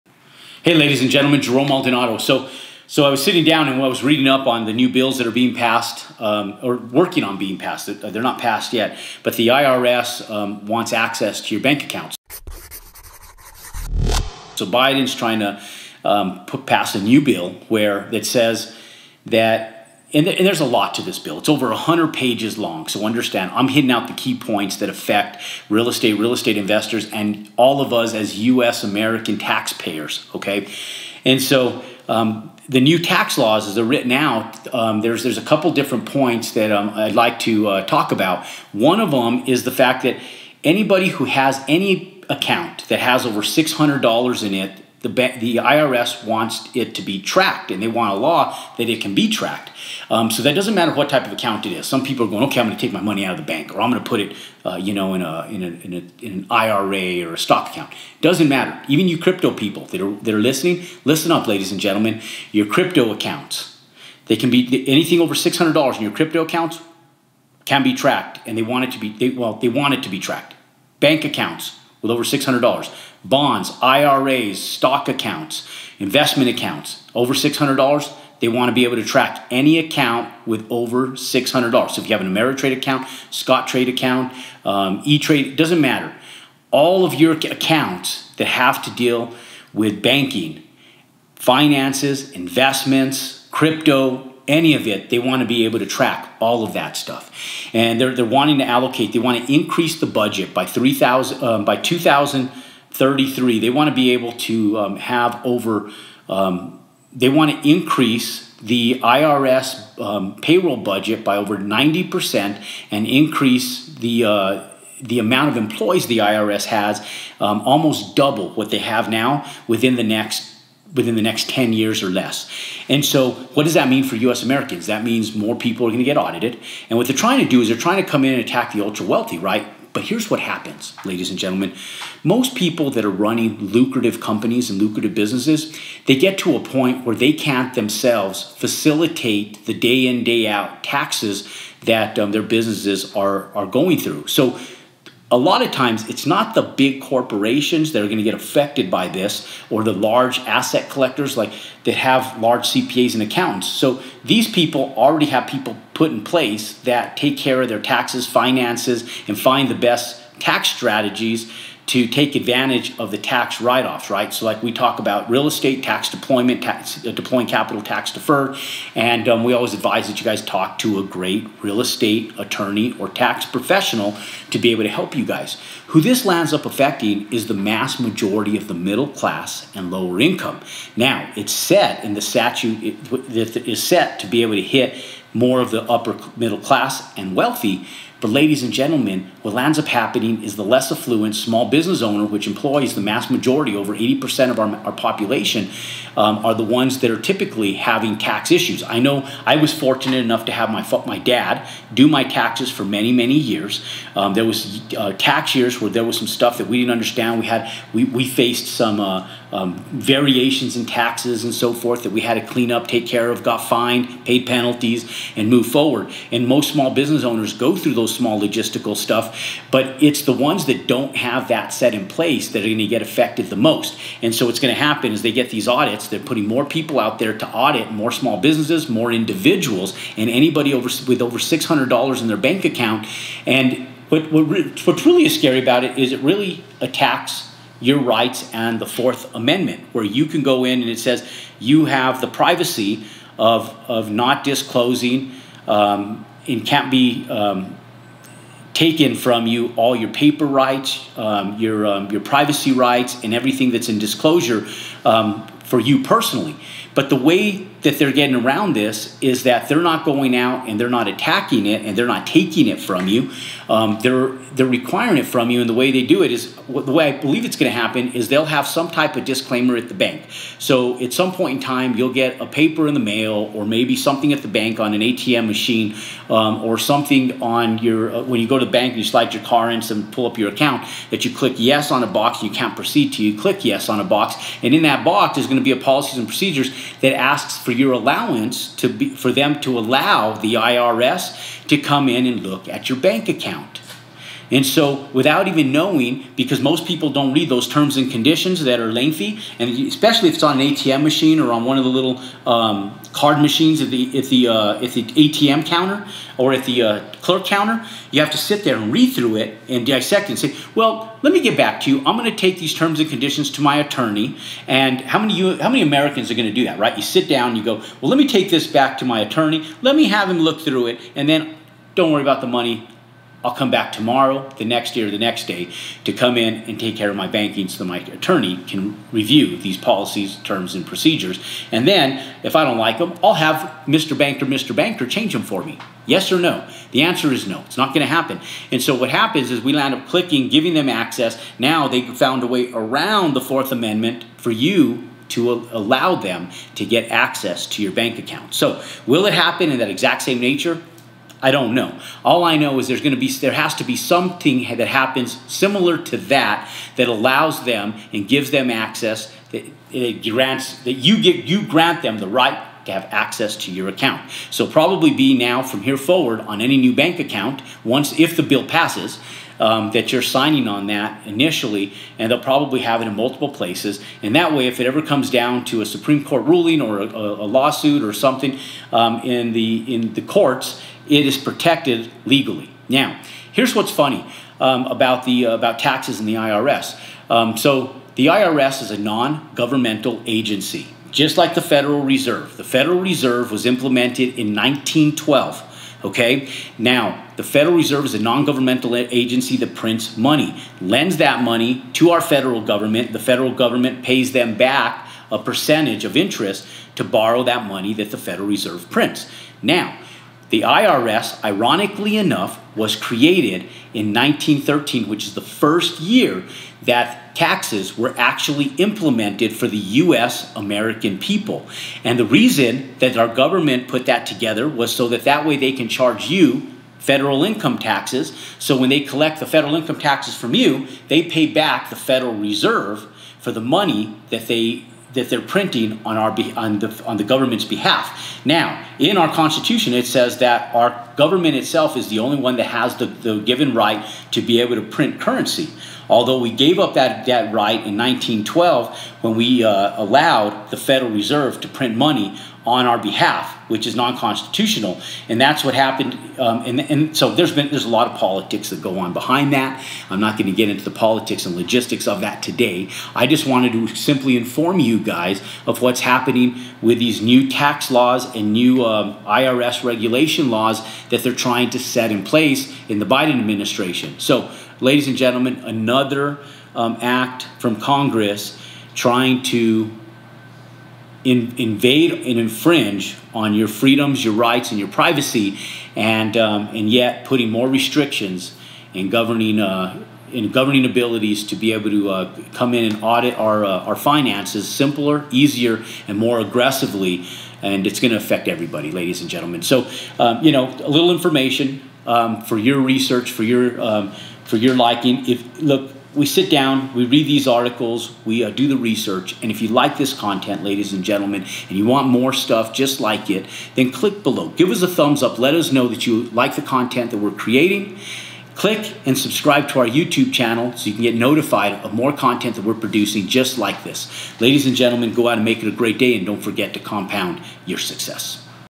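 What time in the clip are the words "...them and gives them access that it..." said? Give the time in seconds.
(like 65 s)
357 s.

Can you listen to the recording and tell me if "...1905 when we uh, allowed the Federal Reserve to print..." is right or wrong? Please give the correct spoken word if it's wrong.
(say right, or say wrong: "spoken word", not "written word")
wrong: "1912", not "1905".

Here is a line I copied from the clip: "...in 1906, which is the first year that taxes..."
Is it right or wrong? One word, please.
wrong.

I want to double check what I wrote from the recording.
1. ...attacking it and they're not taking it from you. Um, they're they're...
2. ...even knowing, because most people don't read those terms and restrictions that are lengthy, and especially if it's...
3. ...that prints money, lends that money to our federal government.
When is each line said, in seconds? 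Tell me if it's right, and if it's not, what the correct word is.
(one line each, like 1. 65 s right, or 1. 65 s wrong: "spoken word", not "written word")
1. 261 s right
2. 295 s wrong: "conditions", not "restrictions"
3. 399 s right.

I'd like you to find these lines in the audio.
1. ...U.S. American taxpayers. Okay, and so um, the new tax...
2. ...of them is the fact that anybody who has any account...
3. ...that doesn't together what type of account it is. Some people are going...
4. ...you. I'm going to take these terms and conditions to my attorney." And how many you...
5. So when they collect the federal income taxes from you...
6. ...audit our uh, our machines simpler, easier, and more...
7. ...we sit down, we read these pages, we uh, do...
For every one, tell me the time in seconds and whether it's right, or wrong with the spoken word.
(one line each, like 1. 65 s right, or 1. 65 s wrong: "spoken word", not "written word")
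1. 28 s right
2. 38 s right
3. 50 s wrong: "matter", not "together"
4. 311 s right
5. 428 s right
6. 493 s wrong: "finances", not "machines"
7. 506 s wrong: "articles", not "pages".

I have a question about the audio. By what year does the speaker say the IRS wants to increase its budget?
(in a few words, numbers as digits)
2033.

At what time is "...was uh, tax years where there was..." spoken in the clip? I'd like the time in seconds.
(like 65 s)
204 s.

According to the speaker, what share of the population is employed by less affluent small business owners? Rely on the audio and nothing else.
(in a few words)
over 80%.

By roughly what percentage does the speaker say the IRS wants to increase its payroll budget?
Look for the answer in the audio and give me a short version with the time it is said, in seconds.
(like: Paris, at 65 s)
over 90%, at 111 s.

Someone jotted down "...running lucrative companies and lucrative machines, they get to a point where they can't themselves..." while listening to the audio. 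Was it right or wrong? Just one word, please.
wrong.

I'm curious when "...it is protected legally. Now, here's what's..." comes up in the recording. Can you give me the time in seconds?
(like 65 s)
381 s.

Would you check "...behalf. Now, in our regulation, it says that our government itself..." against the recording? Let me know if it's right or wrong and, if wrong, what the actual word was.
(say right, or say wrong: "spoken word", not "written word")
wrong: "constitution", not "regulation".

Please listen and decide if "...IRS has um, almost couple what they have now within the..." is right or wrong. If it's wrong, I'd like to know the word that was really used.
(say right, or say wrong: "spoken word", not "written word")
wrong: "double", not "couple".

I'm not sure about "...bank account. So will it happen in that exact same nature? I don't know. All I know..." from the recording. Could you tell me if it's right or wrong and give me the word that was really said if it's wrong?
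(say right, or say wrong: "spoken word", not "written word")
right.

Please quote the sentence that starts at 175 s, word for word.
Who this lands up affecting is the mass majority of the middle class and lower income.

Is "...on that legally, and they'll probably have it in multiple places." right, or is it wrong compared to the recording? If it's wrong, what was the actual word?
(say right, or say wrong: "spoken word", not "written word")
wrong: "initially", not "legally".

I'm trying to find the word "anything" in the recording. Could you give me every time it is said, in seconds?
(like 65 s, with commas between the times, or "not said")
64 s.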